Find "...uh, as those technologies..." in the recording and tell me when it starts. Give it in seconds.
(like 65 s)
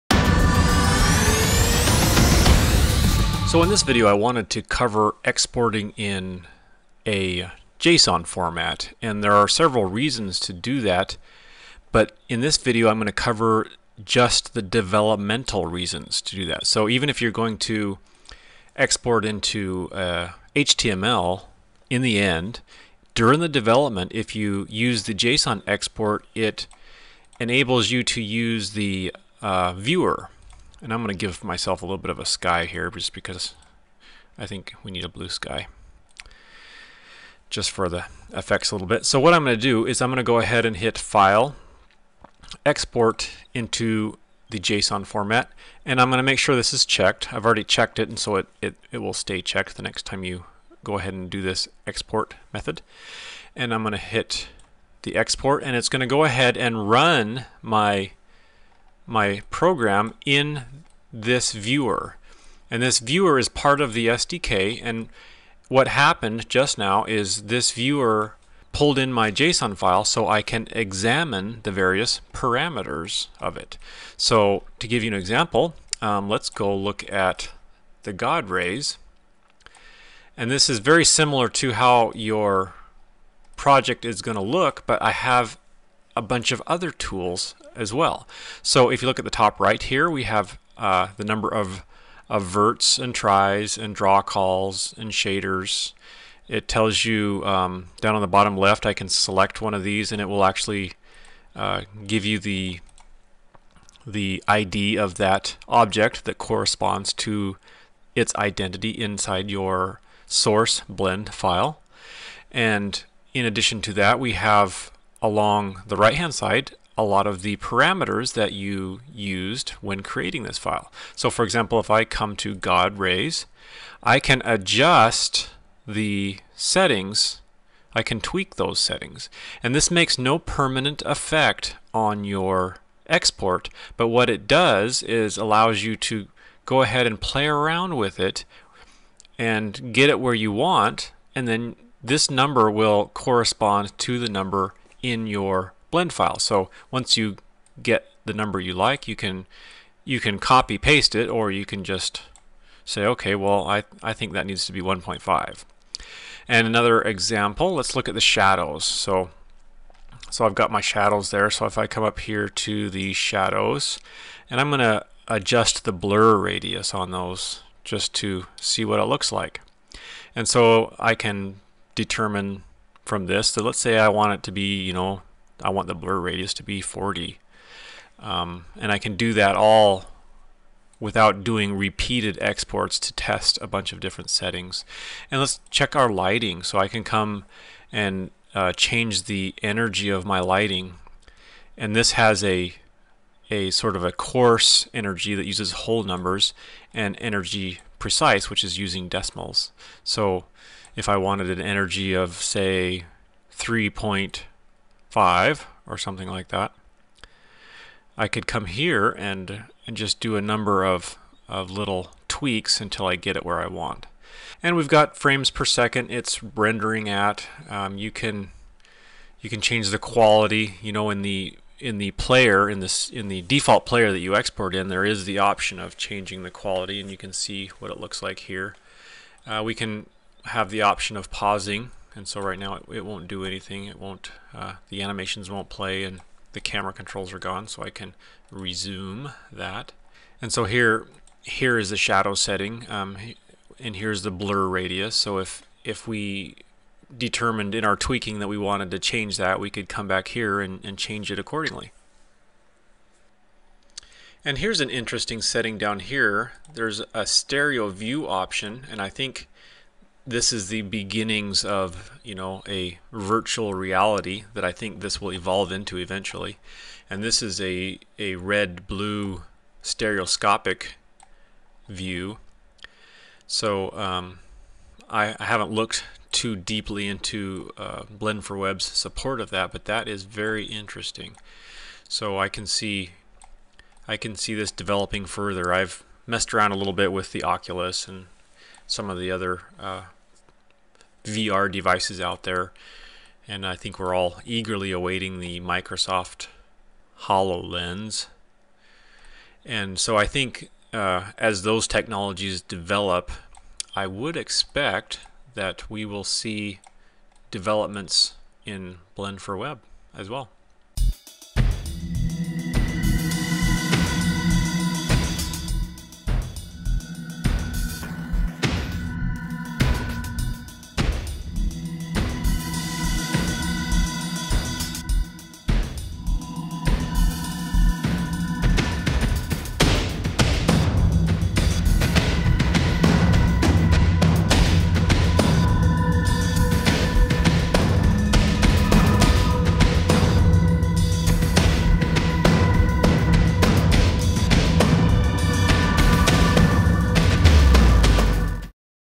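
300 s.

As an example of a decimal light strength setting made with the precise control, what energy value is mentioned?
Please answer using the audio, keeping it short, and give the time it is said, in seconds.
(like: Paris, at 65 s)
3.5, at 203 s.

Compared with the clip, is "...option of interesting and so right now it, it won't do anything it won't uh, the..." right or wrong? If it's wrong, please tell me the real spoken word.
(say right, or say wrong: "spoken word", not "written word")
wrong: "pausing", not "interesting".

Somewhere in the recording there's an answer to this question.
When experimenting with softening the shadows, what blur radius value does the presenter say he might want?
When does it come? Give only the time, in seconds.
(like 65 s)
176 s.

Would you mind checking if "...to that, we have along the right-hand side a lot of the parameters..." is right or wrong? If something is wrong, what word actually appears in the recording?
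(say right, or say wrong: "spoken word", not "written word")
right.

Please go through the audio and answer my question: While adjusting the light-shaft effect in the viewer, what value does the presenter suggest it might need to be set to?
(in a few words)
1.5.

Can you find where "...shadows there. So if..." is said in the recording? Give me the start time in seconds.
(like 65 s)
160 s.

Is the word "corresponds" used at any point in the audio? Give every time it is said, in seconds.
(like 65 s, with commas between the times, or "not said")
106 s, 143 s.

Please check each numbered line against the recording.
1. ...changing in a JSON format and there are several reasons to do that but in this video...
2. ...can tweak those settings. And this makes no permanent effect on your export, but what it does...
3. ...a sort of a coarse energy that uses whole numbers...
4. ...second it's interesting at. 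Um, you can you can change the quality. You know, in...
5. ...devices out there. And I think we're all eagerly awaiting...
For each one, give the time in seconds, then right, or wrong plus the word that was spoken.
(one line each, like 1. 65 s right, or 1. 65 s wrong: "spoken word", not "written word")
1. 5 s wrong: "exporting", not "changing"
2. 128 s right
3. 193 s right
4. 215 s wrong: "rendering", not "interesting"
5. 291 s right.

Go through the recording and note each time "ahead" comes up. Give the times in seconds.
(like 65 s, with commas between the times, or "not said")
40 s, 50 s, 56 s, 136 s.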